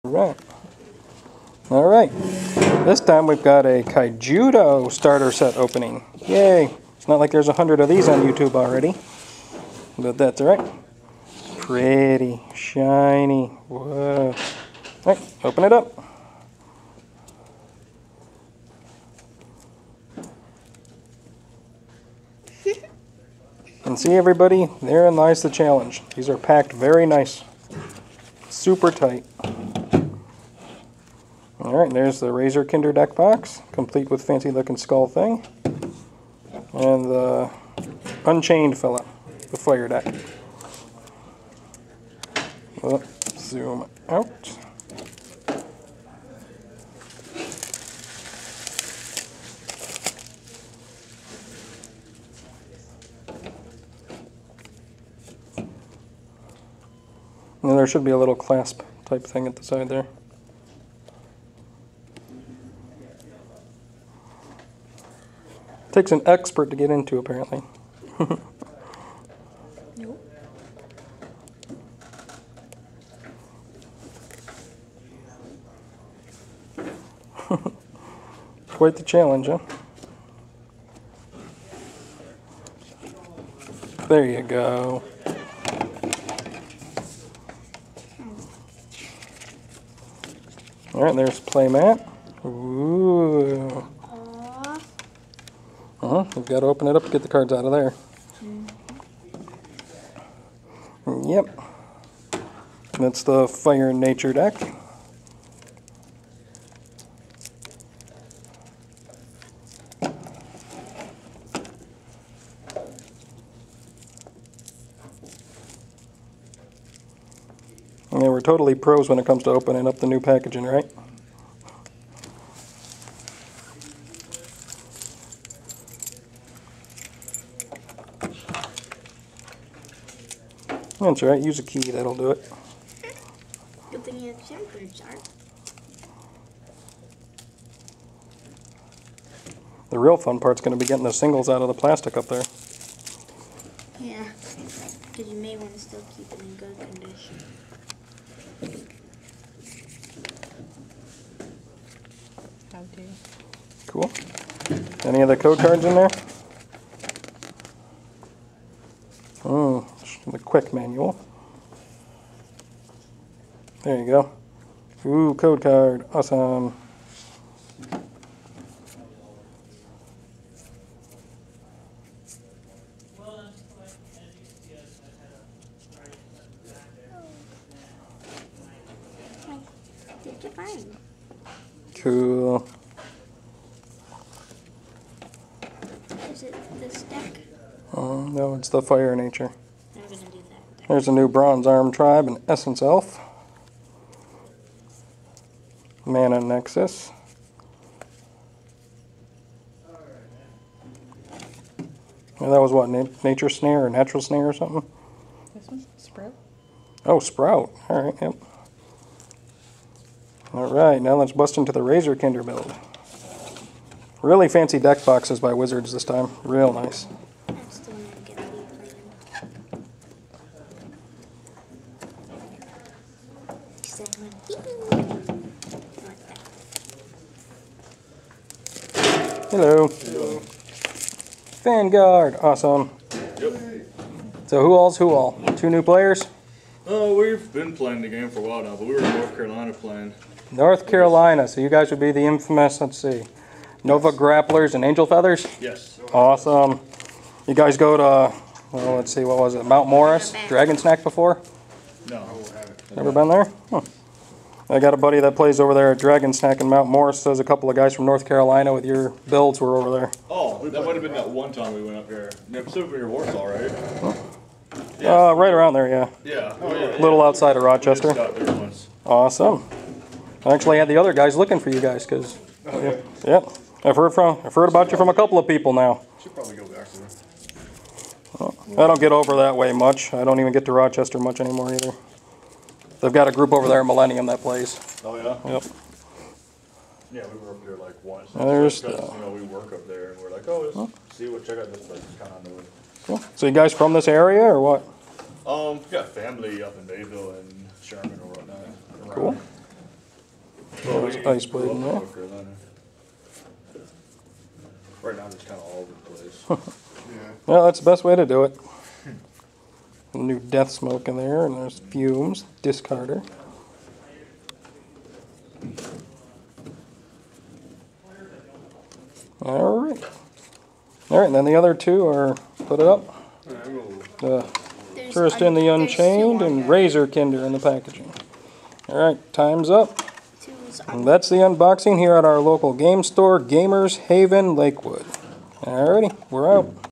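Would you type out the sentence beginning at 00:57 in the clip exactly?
And there should be a little clasp type thing at the side there.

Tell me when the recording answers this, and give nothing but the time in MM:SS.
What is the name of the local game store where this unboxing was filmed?
05:33.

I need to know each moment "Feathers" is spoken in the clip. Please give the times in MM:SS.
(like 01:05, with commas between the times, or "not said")
04:05.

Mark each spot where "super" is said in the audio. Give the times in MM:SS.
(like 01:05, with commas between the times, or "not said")
00:28.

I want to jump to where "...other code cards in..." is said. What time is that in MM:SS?
02:35.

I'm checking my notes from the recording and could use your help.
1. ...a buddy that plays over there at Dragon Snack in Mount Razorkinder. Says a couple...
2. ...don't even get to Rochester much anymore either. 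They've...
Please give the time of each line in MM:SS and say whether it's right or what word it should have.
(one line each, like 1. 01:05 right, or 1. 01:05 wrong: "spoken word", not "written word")
1. 04:14 wrong: "Morris", not "Razorkinder"
2. 04:40 right.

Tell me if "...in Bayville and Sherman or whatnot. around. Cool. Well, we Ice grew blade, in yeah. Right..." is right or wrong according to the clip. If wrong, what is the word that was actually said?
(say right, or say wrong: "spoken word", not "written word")
right.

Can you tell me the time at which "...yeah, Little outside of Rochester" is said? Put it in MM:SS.
04:26.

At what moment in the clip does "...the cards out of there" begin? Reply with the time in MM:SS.
01:37.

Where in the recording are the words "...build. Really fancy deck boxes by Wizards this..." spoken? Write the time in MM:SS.
03:32.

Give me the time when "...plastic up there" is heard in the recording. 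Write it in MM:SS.
02:21.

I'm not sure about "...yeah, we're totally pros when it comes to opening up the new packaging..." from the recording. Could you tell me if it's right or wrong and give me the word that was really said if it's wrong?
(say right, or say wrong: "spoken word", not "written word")
right.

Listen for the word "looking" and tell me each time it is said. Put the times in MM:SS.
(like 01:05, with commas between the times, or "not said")
00:34, 04:31.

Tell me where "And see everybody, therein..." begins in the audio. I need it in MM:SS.
00:23.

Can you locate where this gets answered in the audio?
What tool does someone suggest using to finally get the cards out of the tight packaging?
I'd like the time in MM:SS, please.
02:11.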